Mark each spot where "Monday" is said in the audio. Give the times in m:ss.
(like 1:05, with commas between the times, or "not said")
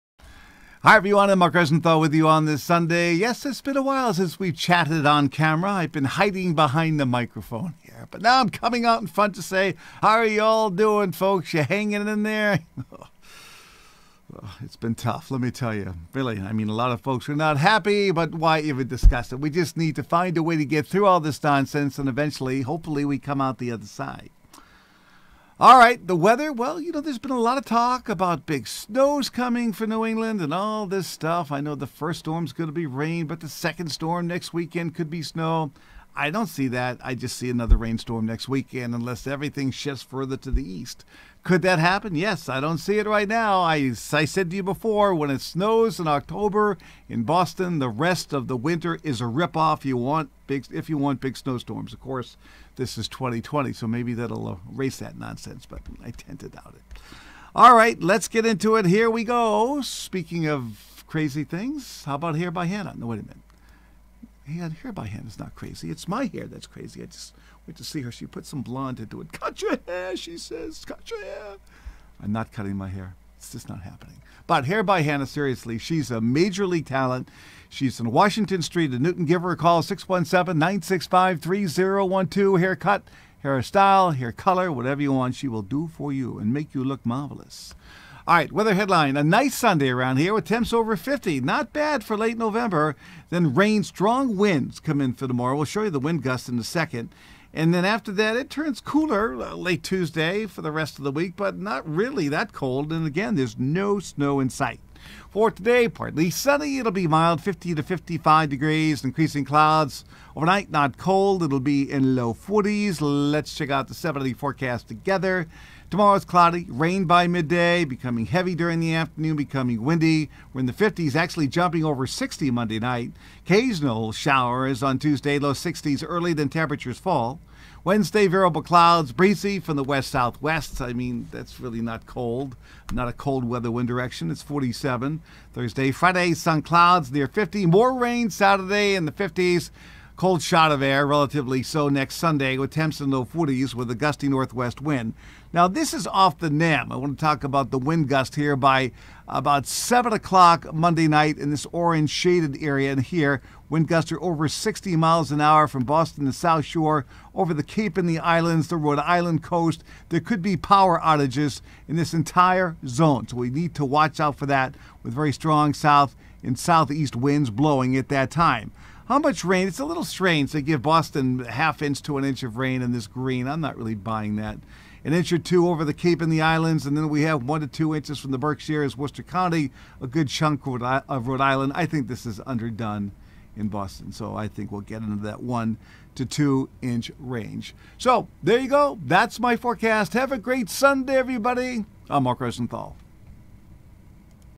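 2:02, 2:30.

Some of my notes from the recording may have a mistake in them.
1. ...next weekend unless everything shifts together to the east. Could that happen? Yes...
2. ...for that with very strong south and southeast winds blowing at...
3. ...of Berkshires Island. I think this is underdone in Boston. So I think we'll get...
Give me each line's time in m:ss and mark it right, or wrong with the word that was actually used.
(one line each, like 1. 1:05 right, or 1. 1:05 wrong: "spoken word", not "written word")
1. 0:38 wrong: "further", not "together"
2. 2:44 right
3. 3:00 wrong: "Rhode", not "Berkshires".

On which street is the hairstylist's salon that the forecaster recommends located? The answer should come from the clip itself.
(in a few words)
Washington Street.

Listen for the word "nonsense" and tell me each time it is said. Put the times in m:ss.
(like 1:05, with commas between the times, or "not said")
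0:21, 0:55.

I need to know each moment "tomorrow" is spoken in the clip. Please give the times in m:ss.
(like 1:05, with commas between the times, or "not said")
1:35, 1:55.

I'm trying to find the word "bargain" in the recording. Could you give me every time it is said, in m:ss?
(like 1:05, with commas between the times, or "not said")
not said.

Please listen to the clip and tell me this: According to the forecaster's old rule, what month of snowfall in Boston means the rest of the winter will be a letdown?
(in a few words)
October.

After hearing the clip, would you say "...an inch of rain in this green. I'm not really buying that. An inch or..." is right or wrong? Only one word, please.
right.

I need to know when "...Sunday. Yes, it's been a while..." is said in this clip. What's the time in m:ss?
0:02.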